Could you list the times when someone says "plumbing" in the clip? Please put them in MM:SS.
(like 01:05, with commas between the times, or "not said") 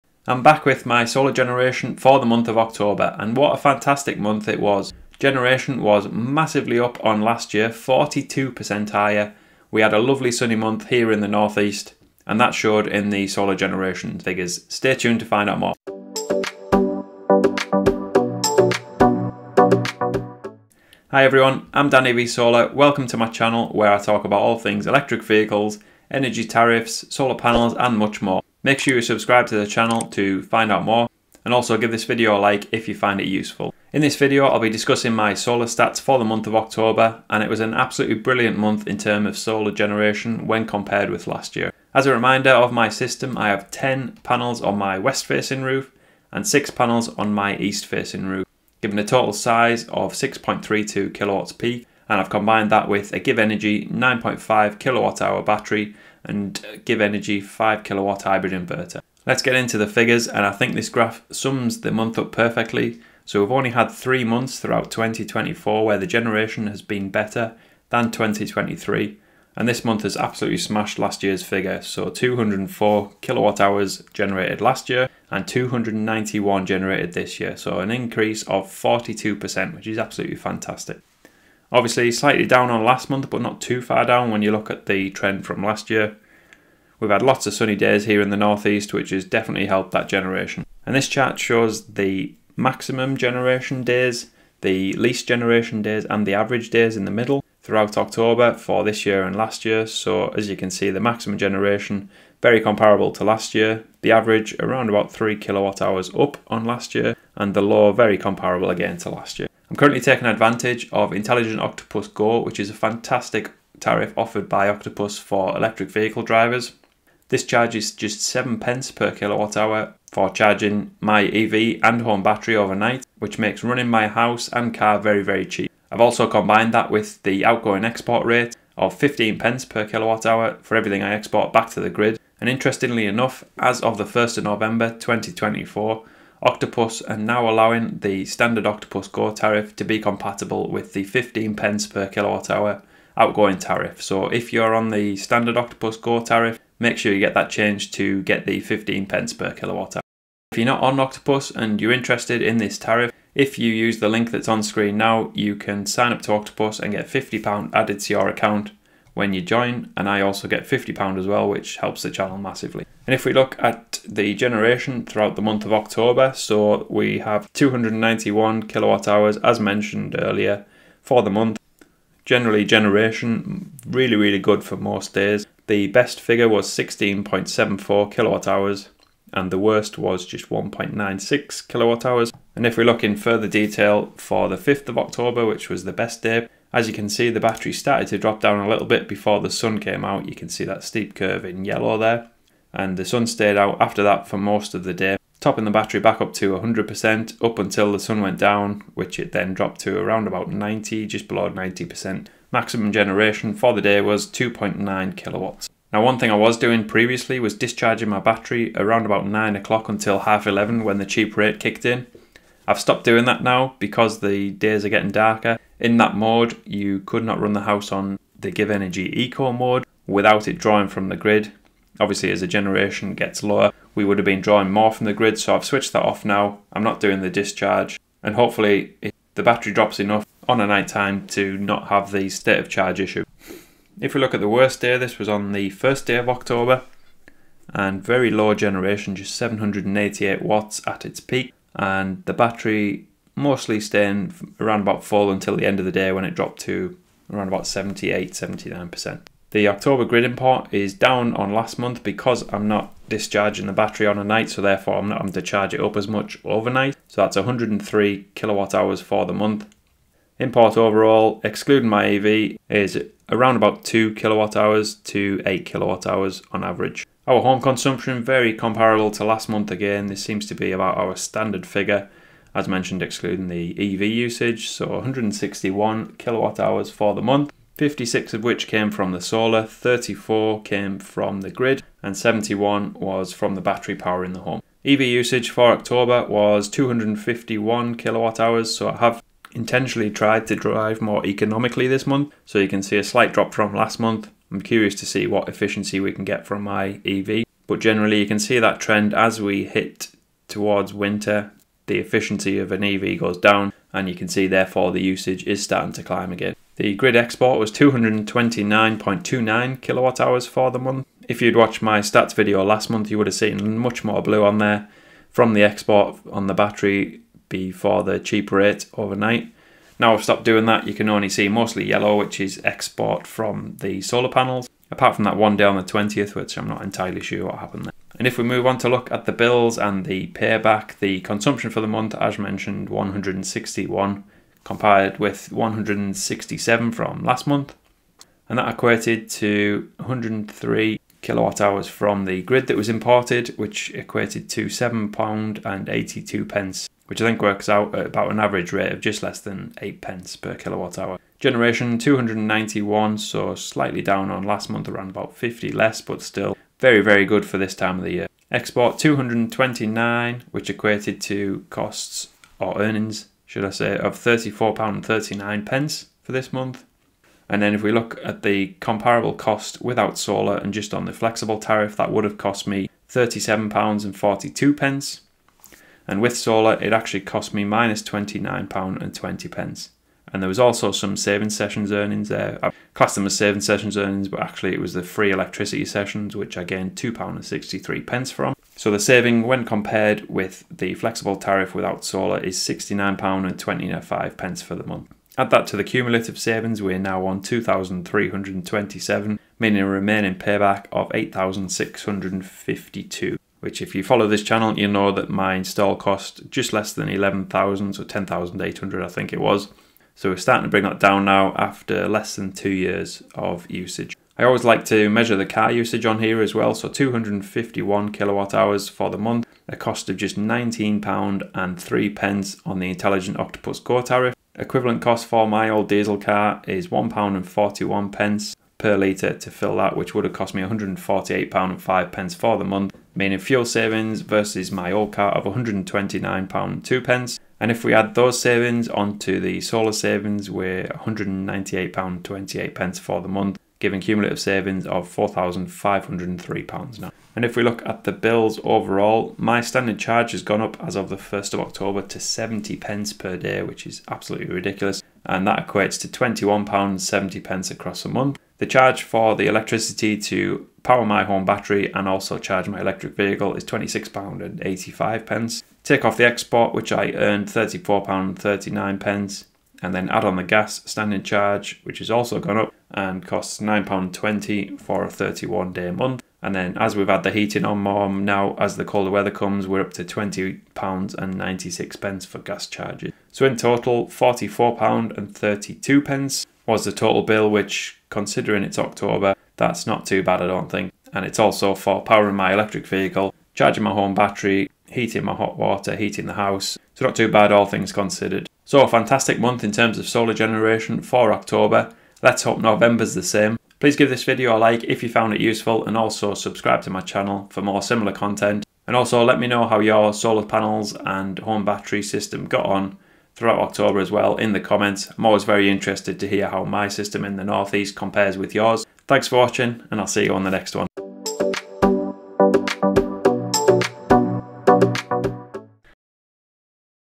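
not said.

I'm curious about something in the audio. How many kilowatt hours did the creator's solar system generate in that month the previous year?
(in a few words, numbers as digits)
204.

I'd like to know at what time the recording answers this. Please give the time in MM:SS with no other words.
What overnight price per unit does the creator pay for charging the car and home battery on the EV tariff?
01:58.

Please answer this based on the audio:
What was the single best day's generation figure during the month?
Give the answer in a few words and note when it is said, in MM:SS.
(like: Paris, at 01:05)
16.74 kWh, at 02:56.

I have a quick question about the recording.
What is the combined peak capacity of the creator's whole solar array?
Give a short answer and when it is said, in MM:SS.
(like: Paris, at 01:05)
6.32 kilowatts peak, at 00:50.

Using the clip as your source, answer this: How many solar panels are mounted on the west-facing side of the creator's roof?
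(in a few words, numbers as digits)
10.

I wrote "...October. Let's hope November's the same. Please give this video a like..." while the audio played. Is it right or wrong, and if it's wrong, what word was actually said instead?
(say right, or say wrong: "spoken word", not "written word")
right.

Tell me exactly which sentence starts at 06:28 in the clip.
So the saving, when compared with the flexible tariff without solar, is £69.25 for the month.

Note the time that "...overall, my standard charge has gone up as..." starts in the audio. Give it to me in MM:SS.
07:28.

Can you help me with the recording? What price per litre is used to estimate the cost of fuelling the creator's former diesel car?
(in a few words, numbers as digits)
£1.41.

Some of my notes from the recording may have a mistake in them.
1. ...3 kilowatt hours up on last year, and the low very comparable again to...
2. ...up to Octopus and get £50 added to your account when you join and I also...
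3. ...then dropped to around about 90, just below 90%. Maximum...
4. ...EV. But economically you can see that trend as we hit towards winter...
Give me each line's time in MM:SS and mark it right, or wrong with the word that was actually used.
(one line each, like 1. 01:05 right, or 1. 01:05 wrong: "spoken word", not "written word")
1. 01:45 right
2. 02:36 right
3. 03:19 right
4. 04:57 wrong: "generally", not "economically".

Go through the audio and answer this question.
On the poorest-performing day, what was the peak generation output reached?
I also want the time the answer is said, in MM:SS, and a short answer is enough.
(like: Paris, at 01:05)
788 watts, at 03:59.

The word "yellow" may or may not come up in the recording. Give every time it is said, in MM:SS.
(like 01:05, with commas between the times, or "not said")
03:11, 05:21.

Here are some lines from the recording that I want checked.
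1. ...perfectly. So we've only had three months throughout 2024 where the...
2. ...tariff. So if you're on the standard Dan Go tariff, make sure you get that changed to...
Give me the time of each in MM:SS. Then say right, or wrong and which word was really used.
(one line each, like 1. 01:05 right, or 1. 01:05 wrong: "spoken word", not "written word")
1. 01:02 right
2. 02:23 wrong: "Octopus", not "Dan".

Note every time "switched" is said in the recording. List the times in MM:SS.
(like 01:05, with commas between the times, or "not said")
03:45.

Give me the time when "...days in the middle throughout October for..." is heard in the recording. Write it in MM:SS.
01:36.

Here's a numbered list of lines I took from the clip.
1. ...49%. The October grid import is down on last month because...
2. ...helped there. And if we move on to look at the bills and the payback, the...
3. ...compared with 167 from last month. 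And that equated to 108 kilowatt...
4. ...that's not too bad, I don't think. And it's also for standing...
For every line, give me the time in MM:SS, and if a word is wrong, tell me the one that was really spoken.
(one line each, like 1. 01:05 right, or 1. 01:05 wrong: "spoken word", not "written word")
1. 04:08 wrong: "79", not "49"
2. 05:27 wrong: "happened", not "helped"
3. 05:34 wrong: "103", not "108"
4. 08:09 wrong: "powering", not "standing".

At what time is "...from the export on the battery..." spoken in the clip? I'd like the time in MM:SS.
05:15.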